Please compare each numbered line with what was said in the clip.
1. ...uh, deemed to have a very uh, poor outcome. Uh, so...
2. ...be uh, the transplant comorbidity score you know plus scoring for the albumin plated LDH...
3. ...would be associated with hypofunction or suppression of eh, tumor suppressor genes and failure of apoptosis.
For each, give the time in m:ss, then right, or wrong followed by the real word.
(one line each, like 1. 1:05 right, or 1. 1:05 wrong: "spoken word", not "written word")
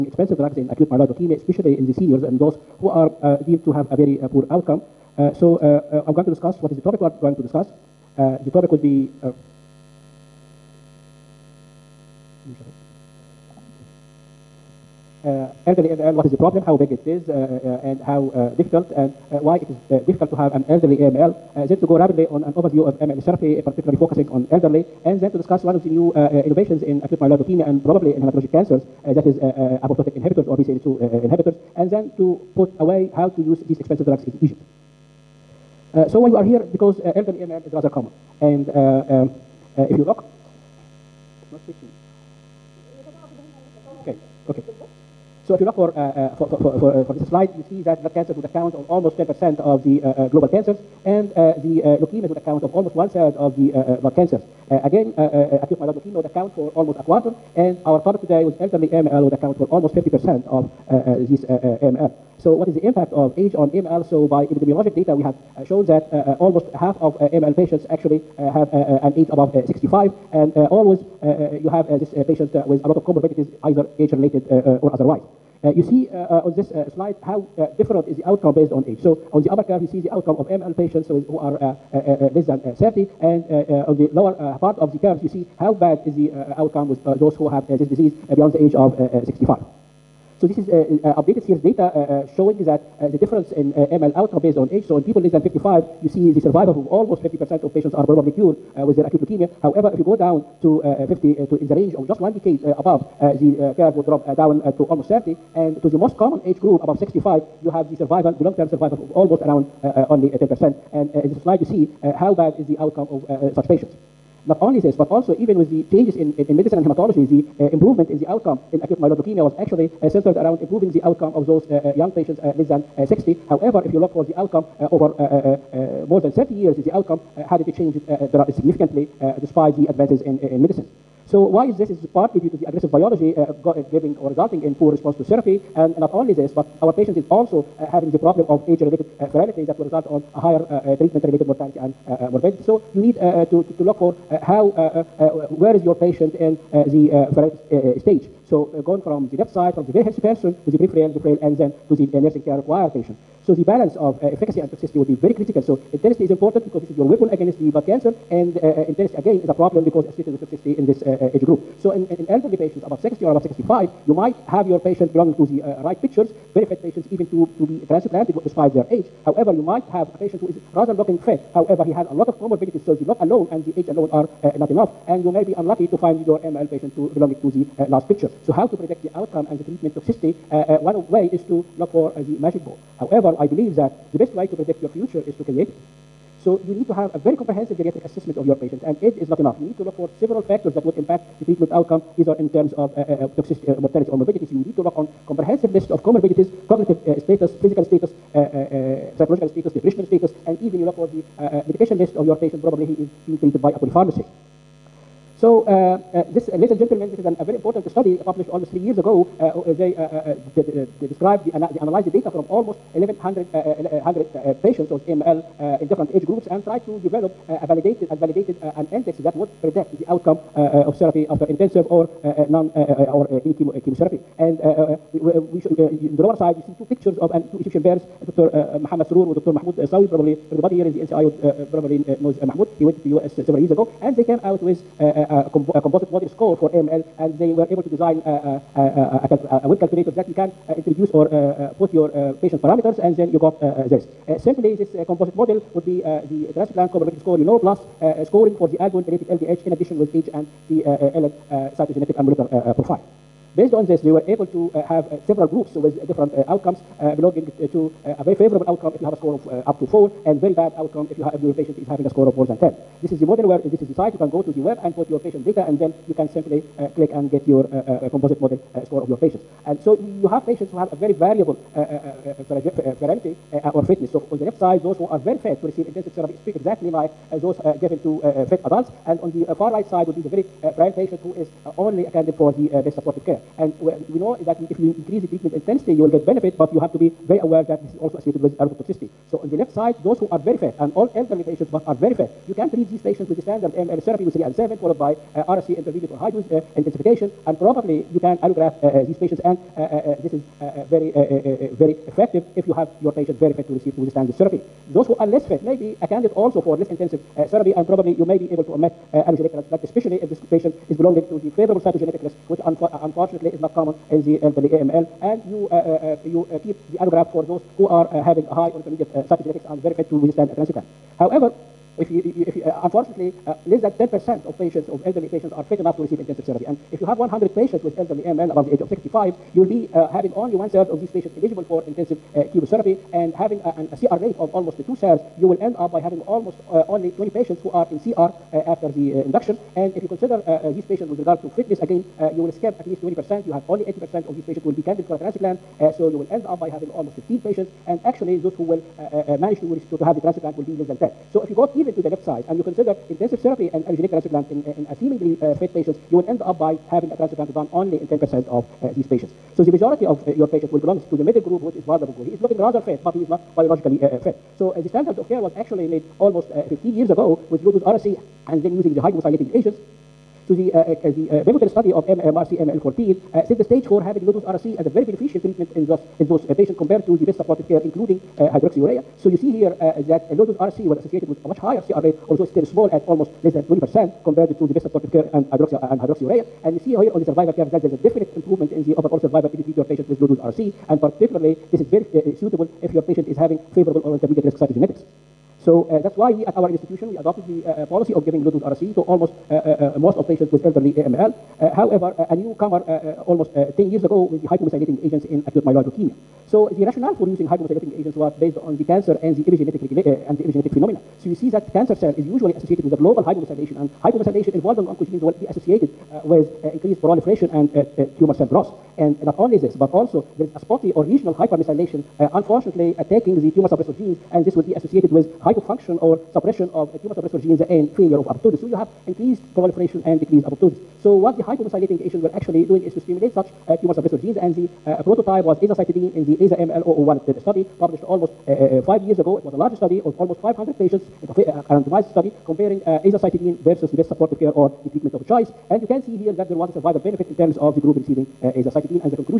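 1. 0:03 right
2. 4:05 right
3. 7:04 right.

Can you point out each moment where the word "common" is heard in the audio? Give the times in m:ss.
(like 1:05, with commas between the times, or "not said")
0:37, 1:46, 5:13.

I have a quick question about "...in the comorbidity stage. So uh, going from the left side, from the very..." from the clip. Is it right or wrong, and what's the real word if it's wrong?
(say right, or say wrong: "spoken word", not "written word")
wrong: "frailty", not "comorbidity".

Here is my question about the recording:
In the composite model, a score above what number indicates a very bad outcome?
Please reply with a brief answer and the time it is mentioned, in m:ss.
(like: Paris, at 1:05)
10, at 4:22.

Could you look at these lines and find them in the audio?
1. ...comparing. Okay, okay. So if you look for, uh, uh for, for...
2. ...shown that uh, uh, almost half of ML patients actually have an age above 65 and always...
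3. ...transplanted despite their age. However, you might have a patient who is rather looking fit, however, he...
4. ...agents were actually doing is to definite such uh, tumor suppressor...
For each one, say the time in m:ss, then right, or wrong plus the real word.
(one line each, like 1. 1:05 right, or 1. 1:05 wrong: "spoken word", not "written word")
1. 0:41 wrong: "switching", not "comparing"
2. 1:05 right
3. 2:47 right
4. 7:12 wrong: "stimulate", not "definite".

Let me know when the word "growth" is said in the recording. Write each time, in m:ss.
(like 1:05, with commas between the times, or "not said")
6:58.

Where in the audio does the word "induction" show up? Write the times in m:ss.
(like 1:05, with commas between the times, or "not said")
5:39.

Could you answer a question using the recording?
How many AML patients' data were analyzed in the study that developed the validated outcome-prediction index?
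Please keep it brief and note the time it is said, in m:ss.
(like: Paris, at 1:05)
1,100, at 3:32.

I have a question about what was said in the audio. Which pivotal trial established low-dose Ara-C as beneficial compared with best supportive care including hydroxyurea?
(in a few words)
MRC AML14.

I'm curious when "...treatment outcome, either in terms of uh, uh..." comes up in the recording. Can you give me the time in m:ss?
3:11.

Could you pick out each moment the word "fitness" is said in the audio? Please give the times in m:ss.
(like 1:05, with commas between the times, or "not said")
4:33, 5:41.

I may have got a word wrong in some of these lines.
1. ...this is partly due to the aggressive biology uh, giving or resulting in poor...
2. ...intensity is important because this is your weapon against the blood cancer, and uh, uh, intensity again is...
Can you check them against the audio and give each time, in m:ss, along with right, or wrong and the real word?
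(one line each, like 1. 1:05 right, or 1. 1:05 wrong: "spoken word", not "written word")
1. 2:11 right
2. 2:35 right.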